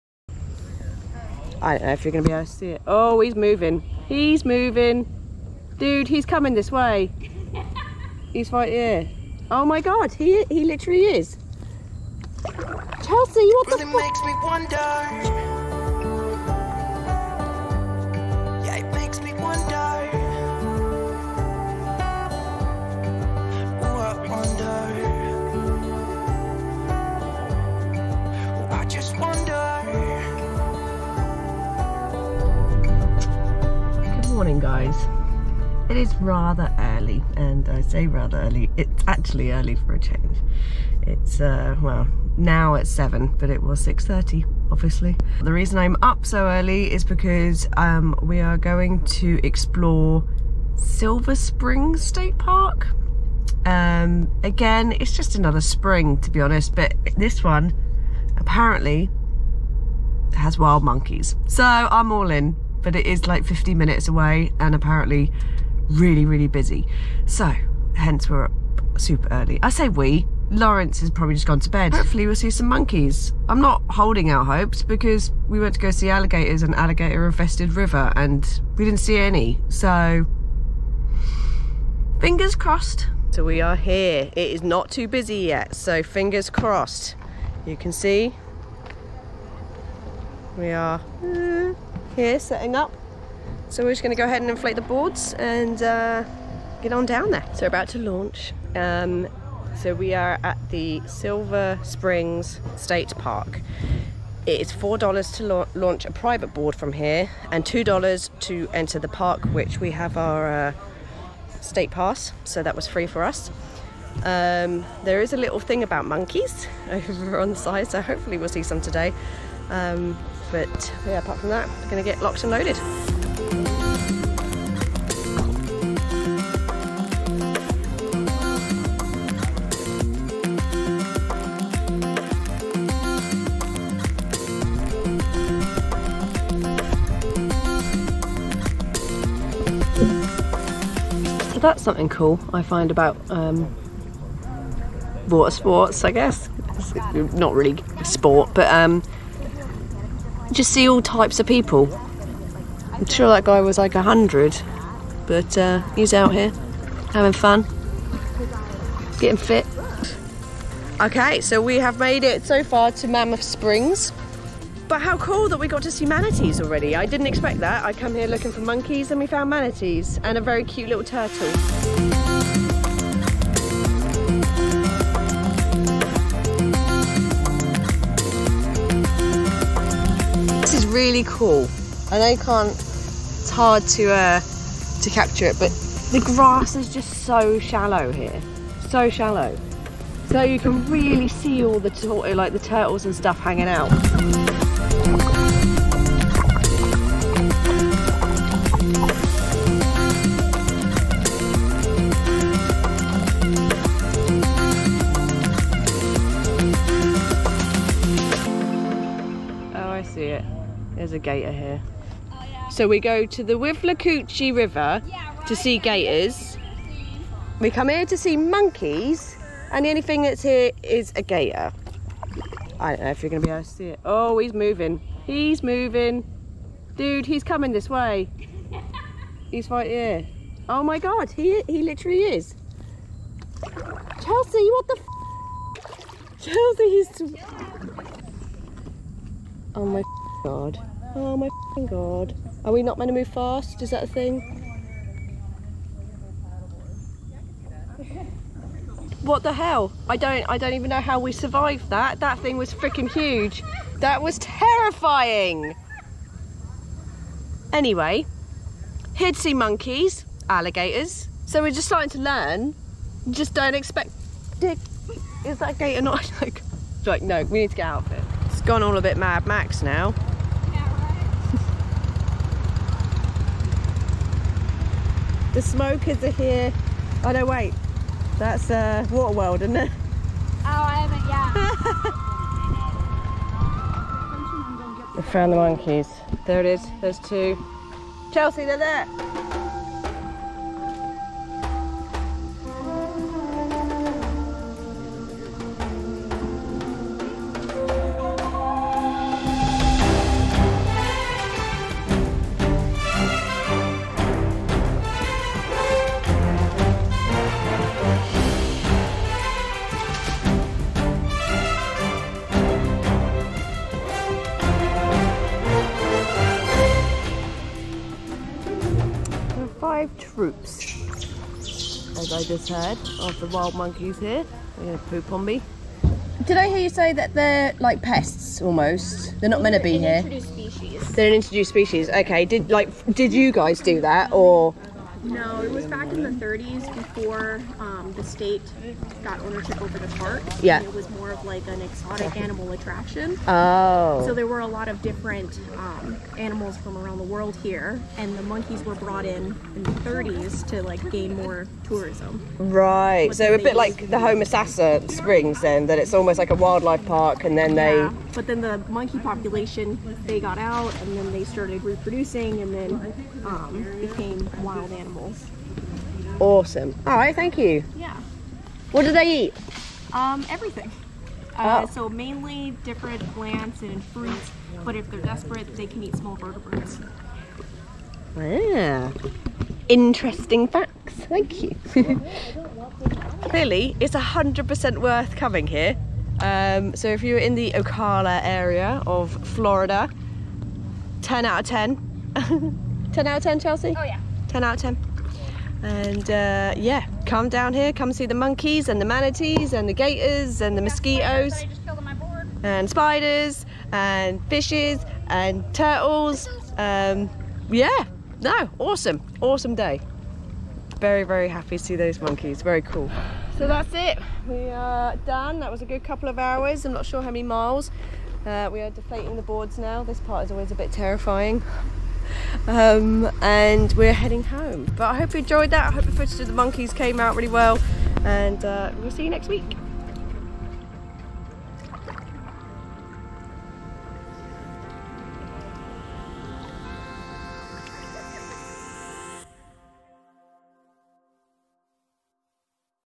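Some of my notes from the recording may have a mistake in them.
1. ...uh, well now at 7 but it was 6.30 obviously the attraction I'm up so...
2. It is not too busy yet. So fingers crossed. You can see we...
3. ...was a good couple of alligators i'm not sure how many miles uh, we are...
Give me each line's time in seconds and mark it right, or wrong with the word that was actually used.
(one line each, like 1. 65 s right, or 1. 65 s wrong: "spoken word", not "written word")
1. 41 s wrong: "reason", not "attraction"
2. 84 s right
3. 415 s wrong: "hours", not "alligators".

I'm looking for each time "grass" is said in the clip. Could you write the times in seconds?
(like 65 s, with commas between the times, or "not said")
186 s.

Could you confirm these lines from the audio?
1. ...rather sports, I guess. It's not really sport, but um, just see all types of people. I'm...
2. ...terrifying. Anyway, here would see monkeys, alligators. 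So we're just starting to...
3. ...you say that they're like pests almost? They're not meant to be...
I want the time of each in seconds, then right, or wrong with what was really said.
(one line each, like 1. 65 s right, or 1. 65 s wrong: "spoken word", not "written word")
1. 145 s wrong: "water", not "rather"
2. 254 s right
3. 326 s right.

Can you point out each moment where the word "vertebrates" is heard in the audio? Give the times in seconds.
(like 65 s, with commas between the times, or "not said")
376 s.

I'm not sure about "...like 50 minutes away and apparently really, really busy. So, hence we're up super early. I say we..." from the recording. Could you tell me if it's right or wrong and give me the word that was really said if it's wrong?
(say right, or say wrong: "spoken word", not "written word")
right.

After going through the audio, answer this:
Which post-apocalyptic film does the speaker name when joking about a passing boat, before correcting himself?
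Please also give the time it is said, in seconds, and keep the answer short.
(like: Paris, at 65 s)
Waterworld, at 279 s.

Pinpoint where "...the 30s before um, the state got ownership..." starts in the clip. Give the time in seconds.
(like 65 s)
336 s.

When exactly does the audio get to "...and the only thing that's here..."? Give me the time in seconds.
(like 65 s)
219 s.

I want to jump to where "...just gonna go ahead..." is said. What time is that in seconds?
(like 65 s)
93 s.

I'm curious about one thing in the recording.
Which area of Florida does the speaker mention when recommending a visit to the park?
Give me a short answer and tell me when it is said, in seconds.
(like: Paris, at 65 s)
Ocala, at 387 s.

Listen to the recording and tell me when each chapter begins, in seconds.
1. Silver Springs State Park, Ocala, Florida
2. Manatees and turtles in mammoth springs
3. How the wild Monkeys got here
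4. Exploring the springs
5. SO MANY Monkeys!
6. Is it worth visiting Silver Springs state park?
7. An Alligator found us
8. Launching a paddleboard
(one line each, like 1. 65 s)
1. 34 s
2. 162 s
3. 319 s
4. 123 s
5. 269 s
6. 383 s
7. 209 s
8. 83 s.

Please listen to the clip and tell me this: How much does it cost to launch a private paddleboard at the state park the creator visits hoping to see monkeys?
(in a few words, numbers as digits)
$4.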